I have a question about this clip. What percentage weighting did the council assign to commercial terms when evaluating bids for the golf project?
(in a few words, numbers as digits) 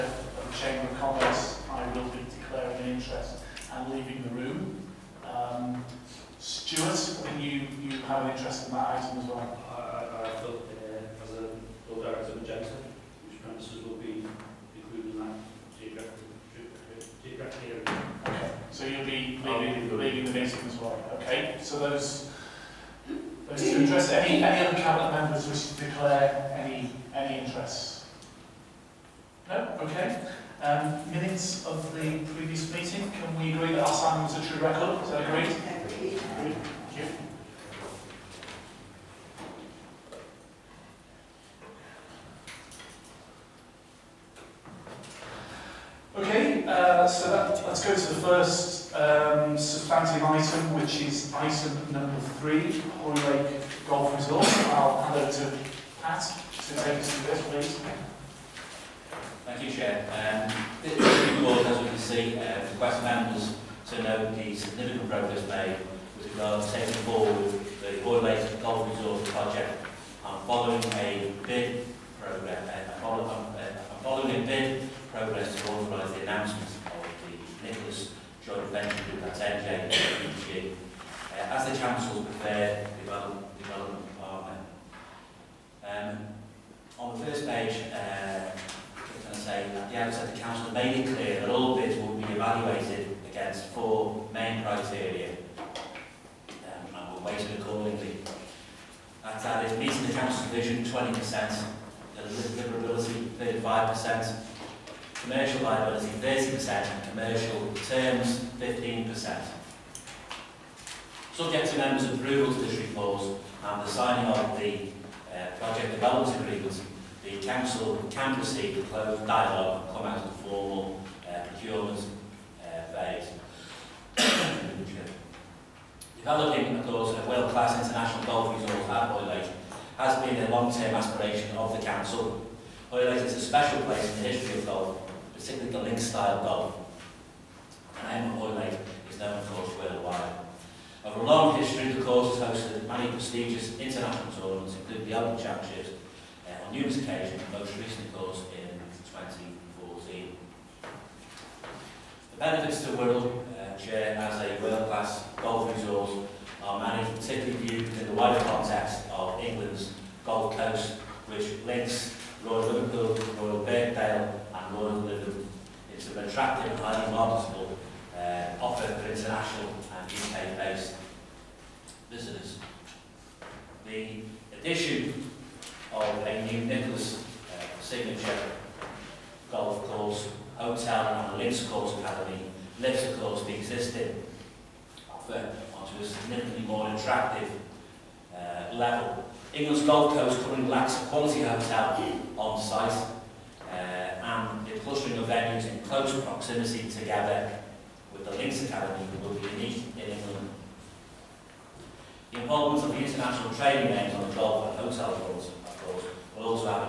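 15%.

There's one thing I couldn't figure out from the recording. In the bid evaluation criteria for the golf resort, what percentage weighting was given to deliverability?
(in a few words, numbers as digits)
35%.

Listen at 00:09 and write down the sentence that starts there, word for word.
I, I, feel, uh, as a Director of Agenda, which premises will be included in that geographic area.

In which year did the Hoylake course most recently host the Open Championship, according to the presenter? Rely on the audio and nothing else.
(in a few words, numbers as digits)
2014.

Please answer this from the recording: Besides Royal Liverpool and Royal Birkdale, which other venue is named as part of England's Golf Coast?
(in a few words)
Royal Lytham.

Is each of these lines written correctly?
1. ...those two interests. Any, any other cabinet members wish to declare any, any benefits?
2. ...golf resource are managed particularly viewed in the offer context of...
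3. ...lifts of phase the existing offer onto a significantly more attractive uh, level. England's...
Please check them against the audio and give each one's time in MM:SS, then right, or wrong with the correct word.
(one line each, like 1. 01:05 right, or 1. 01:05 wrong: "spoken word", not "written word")
1. 00:23 wrong: "interests", not "benefits"
2. 02:35 wrong: "wider", not "offer"
3. 03:02 wrong: "course", not "phase".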